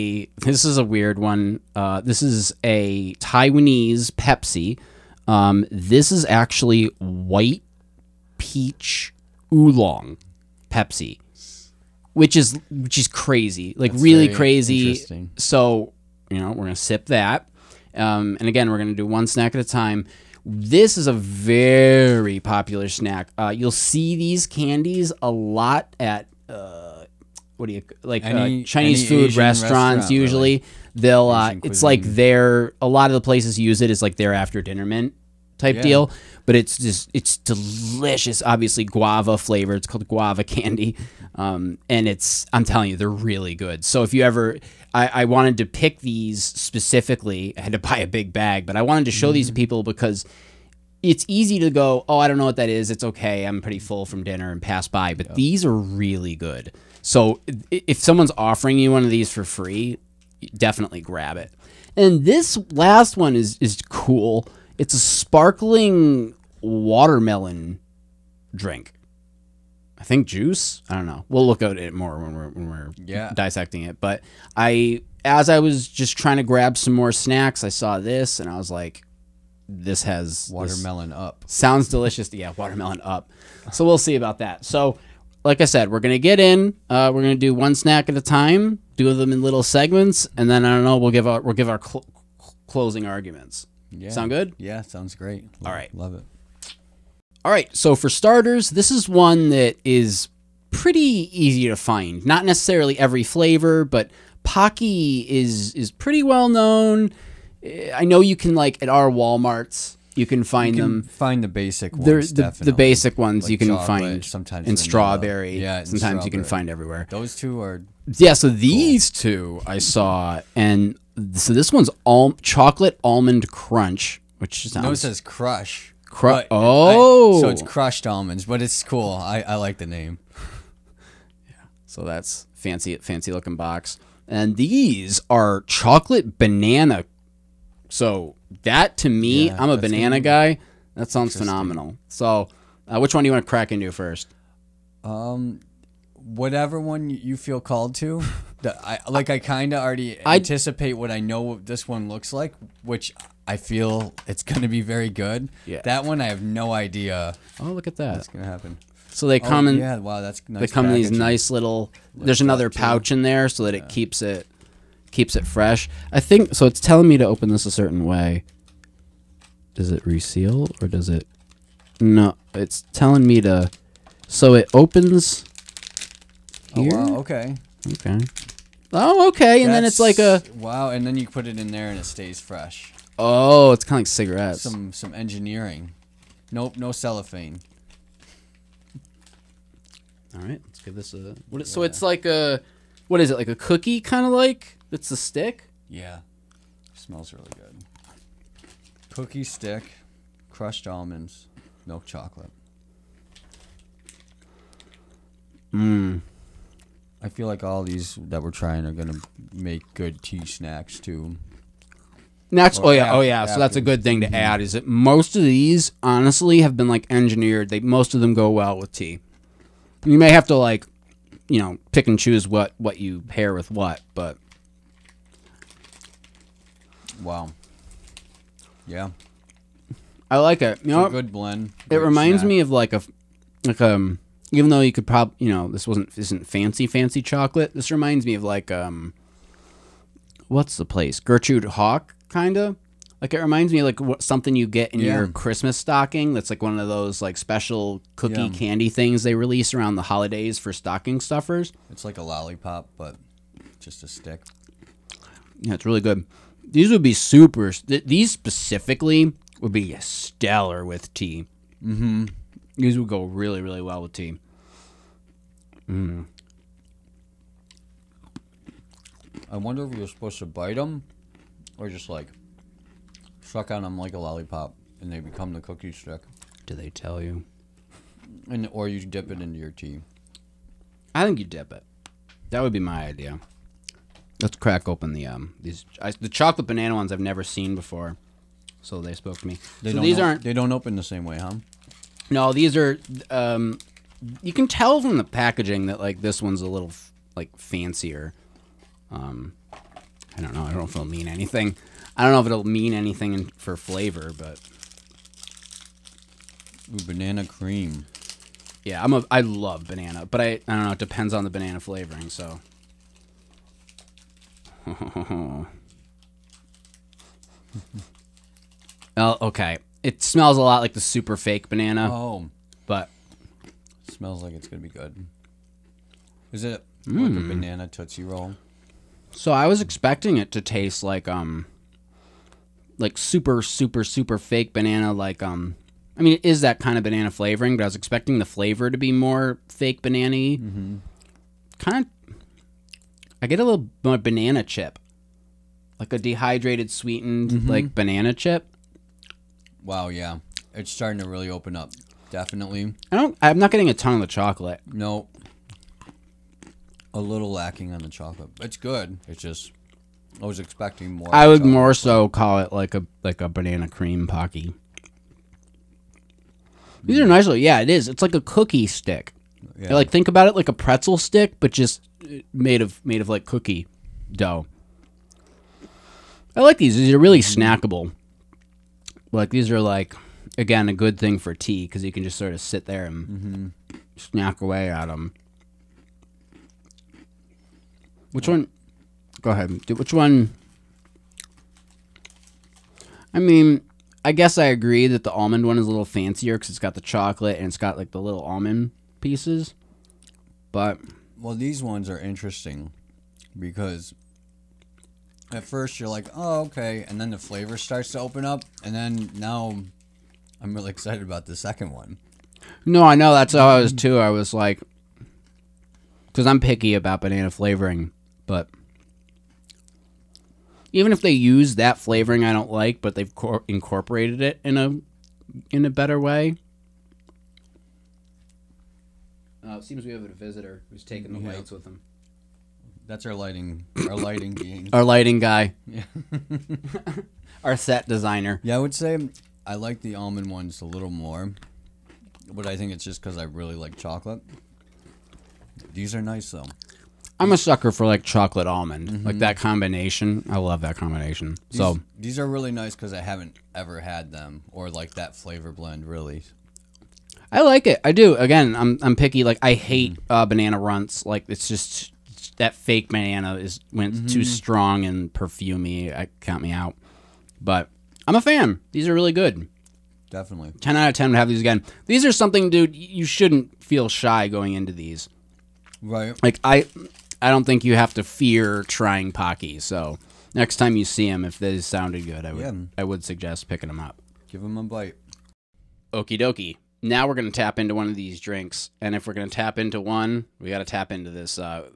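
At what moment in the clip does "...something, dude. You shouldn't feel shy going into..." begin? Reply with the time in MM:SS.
07:52.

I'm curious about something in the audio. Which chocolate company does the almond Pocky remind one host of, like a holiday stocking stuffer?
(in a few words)
Gertrude Hawk.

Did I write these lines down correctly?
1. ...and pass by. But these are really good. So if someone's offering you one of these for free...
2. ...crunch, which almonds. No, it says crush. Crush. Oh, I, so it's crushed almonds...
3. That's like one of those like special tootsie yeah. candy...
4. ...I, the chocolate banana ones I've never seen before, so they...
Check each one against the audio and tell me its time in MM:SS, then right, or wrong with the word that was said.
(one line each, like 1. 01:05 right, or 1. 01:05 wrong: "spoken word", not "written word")
1. 00:54 right
2. 02:03 wrong: "sounds", not "almonds"
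3. 04:06 wrong: "cookie", not "tootsie"
4. 04:46 right.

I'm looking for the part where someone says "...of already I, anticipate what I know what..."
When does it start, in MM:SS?
02:29.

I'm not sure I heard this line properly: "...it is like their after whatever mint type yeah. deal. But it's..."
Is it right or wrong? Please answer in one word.
wrong.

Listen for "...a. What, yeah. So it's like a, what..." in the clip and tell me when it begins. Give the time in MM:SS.
03:11.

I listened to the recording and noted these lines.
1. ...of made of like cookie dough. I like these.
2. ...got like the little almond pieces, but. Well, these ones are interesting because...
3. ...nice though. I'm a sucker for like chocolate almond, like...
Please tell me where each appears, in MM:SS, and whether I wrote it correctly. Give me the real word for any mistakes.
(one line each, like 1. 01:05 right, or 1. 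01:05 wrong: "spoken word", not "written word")
1. 06:12 right
2. 06:37 right
3. 07:26 right.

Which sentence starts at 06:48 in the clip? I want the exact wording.
And then now I'm really excited about the second one.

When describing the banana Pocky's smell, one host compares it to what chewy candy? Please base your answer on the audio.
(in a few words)
Tootsie Roll.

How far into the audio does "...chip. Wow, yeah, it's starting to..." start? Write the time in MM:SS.
05:48.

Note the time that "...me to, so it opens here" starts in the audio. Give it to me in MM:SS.
02:53.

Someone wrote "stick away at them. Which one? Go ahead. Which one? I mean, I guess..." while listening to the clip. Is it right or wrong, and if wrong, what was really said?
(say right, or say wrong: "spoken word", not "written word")
wrong: "snack", not "stick".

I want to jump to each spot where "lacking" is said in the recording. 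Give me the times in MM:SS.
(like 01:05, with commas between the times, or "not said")
05:57.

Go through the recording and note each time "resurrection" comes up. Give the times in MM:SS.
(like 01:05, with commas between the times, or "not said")
not said.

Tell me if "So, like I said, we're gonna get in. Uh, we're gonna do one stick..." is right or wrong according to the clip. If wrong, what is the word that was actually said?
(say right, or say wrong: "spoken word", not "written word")
wrong: "snack", not "stick".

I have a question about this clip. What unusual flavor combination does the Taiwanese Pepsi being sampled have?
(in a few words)
White peach oolong.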